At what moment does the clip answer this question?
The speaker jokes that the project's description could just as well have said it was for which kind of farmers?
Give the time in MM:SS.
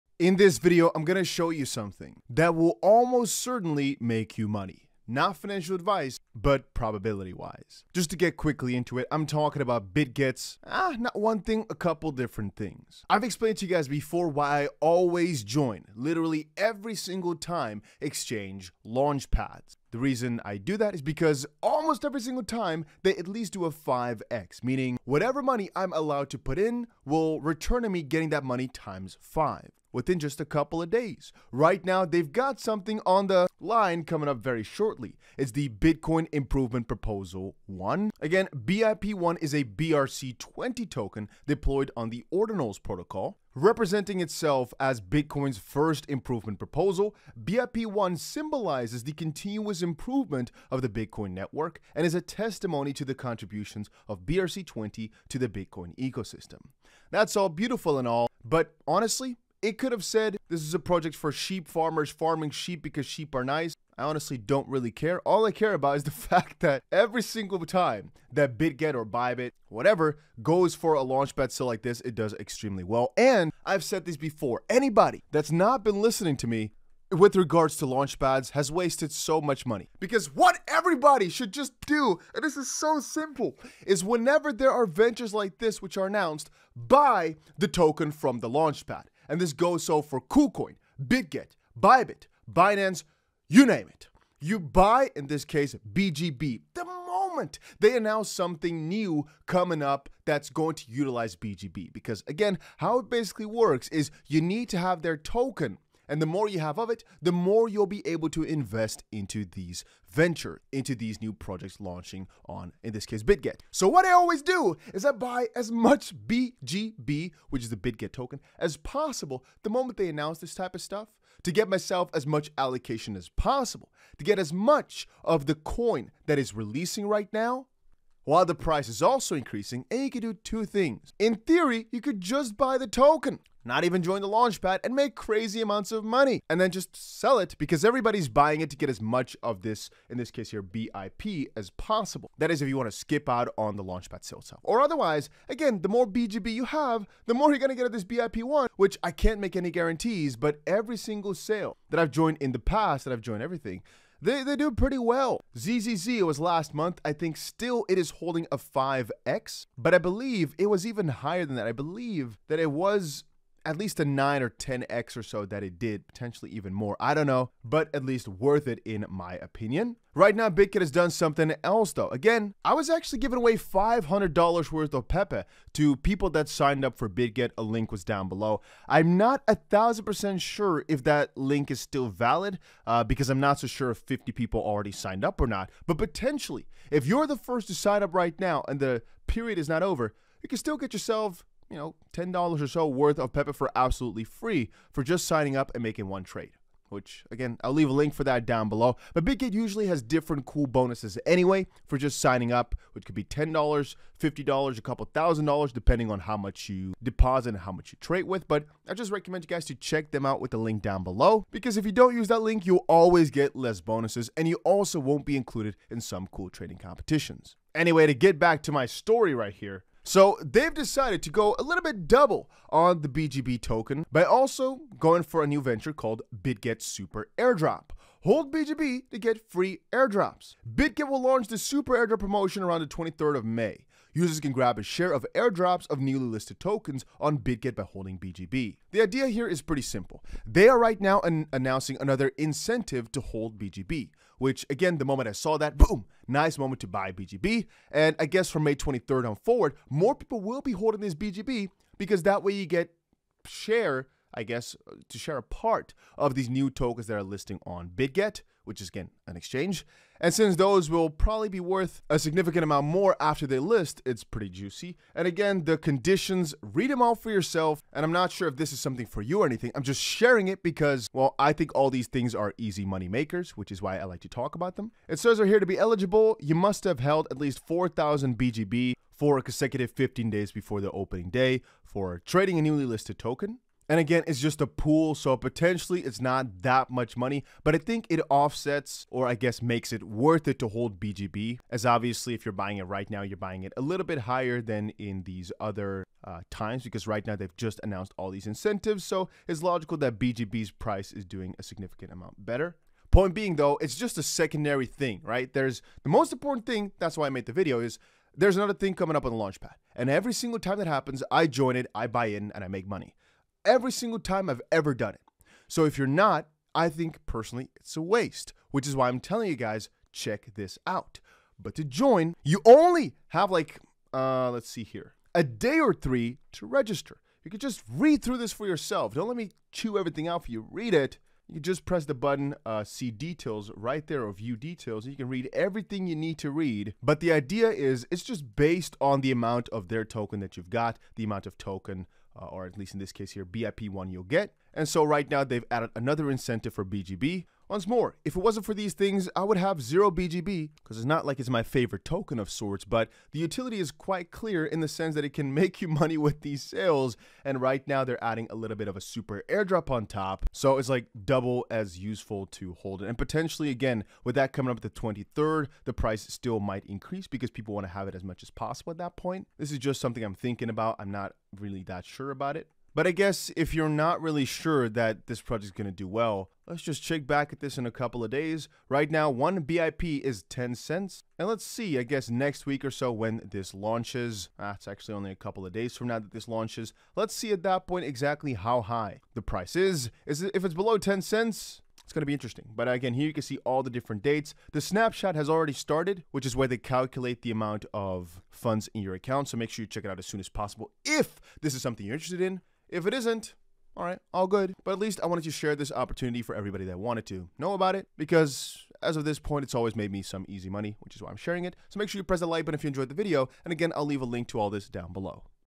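01:01.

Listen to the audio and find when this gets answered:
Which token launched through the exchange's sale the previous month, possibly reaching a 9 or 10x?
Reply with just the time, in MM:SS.
02:35.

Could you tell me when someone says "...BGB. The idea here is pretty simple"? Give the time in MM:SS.
03:58.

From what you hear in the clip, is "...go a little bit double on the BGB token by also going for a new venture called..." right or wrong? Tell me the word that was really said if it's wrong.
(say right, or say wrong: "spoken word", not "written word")
right.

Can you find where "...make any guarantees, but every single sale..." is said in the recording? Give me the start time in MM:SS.
02:29.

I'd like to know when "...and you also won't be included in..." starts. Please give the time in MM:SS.
03:34.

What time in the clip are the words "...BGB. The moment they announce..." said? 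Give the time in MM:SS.
01:35.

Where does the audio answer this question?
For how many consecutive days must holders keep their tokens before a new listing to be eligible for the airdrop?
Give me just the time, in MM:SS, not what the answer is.
04:39.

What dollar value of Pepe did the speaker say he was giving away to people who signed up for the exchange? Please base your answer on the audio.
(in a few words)
$500.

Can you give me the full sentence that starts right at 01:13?
And I've said this before, anybody that's not been listening to me with regards to launchpads has wasted so much money.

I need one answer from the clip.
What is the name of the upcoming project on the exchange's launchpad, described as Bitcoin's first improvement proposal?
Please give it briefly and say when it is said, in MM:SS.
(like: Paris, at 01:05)
Bitcoin Improvement Proposal 1, at 00:35.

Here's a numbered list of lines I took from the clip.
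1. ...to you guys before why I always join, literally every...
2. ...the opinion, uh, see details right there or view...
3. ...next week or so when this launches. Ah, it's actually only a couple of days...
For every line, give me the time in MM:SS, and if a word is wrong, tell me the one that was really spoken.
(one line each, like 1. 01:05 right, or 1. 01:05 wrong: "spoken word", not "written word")
1. 00:13 right
2. 05:32 wrong: "button", not "opinion"
3. 06:22 right.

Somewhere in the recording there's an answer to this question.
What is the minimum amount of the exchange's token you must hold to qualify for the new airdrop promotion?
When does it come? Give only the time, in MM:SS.
04:37.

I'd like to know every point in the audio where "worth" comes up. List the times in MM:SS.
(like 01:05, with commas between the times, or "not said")
02:48, 02:54, 03:12, 04:21, 04:50.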